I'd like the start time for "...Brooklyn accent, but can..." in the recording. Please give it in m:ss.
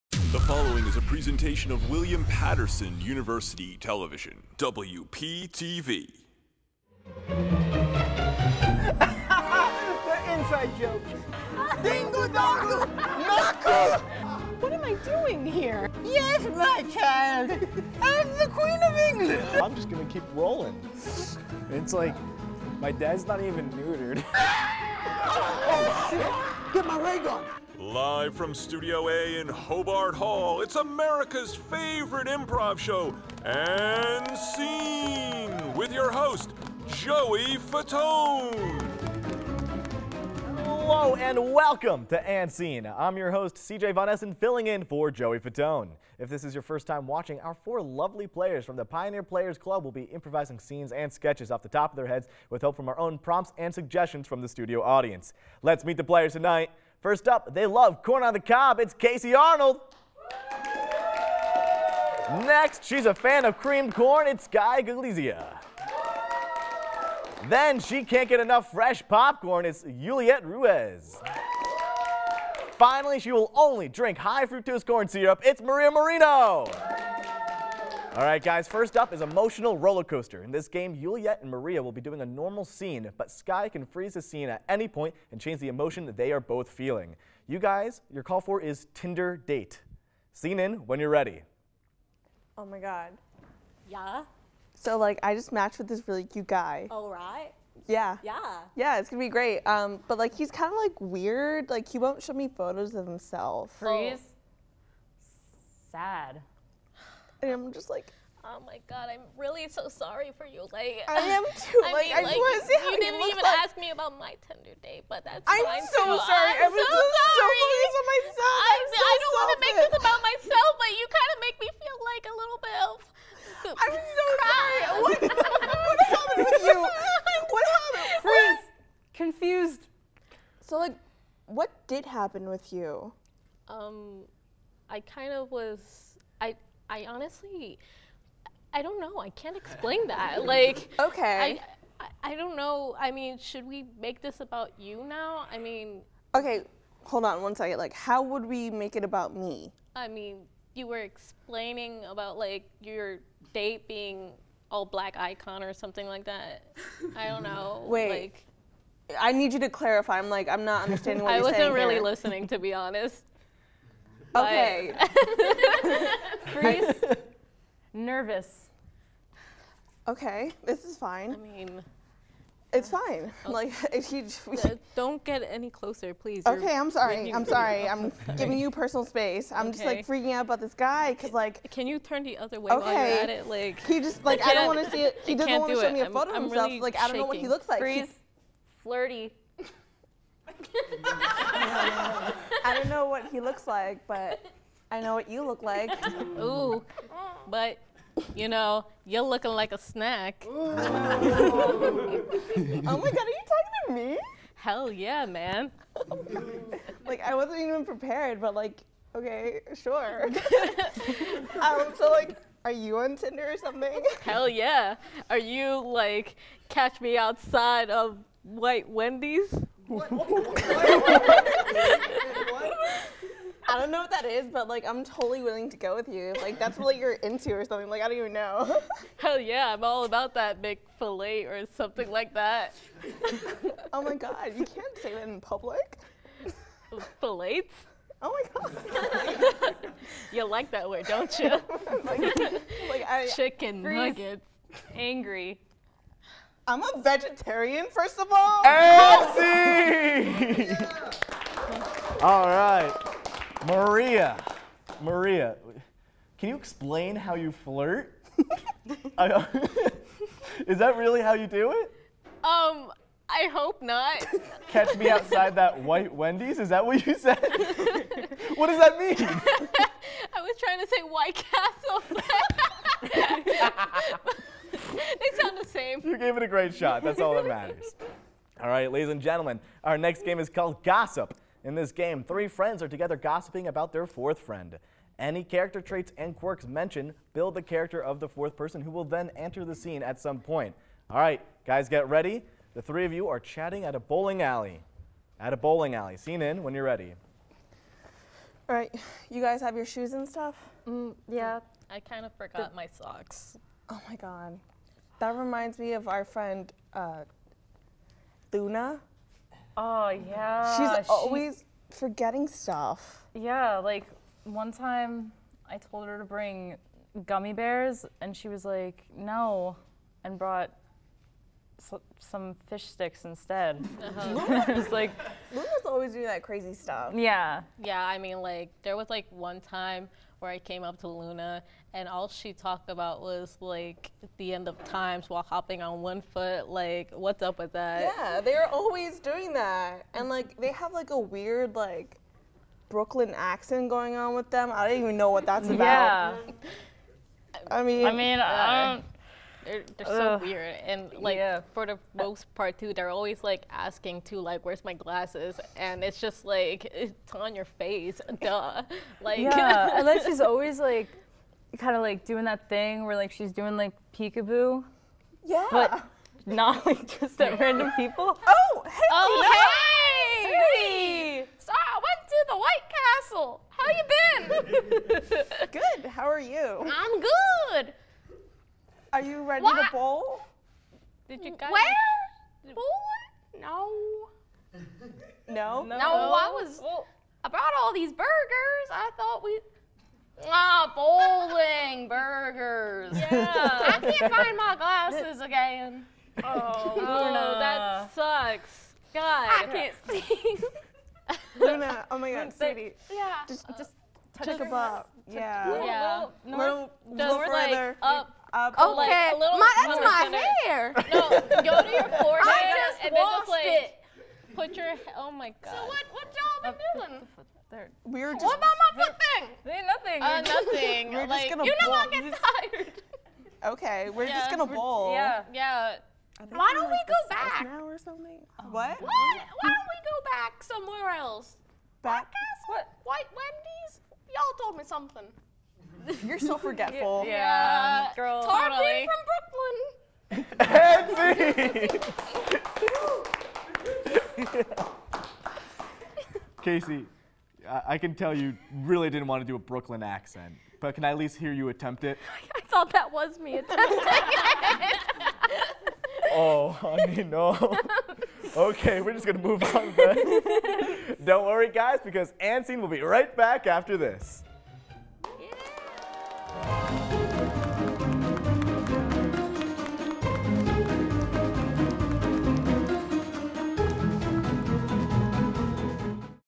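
7:29.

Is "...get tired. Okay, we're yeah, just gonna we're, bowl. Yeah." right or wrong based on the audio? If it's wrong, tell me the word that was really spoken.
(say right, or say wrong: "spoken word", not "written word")
right.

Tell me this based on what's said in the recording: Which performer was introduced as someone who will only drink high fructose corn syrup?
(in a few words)
Maria Moreno.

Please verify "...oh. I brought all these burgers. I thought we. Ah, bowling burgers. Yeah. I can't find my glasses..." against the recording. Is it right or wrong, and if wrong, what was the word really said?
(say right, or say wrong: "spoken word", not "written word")
right.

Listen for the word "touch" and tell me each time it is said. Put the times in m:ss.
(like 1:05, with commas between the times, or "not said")
6:44.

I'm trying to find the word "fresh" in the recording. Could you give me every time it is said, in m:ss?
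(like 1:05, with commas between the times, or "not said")
1:08.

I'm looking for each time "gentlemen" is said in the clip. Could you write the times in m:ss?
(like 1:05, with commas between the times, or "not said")
4:39.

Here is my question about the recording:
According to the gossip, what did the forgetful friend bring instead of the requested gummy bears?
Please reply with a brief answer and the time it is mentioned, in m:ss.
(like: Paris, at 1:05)
fish sticks, at 5:22.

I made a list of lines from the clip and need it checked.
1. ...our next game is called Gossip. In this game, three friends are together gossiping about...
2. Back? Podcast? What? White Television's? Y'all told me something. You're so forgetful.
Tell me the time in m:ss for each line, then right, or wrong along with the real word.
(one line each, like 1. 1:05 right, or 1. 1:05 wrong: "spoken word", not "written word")
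1. 4:39 right
2. 7:12 wrong: "Wendy", not "Television".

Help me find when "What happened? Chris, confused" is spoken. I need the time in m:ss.
2:06.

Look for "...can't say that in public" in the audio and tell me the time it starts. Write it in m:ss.
3:54.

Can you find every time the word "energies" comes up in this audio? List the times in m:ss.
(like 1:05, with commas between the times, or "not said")
not said.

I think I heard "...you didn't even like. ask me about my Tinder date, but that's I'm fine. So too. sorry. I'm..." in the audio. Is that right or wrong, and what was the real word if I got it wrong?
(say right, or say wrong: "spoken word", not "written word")
right.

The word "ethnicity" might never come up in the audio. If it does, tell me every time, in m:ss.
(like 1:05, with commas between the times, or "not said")
not said.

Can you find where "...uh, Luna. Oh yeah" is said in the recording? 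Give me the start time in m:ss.
5:06.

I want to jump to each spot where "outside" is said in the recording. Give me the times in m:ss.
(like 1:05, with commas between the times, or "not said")
3:37, 4:25.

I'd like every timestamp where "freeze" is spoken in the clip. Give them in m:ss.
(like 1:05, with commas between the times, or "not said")
1:23, 1:43, 2:46, 3:07, 4:03.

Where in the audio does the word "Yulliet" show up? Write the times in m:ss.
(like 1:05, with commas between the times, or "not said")
1:09, 1:20.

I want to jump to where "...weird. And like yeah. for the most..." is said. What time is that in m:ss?
5:50.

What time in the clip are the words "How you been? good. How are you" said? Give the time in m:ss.
6:13.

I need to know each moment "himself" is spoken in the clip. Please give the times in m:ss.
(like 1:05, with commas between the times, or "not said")
1:43, 3:06.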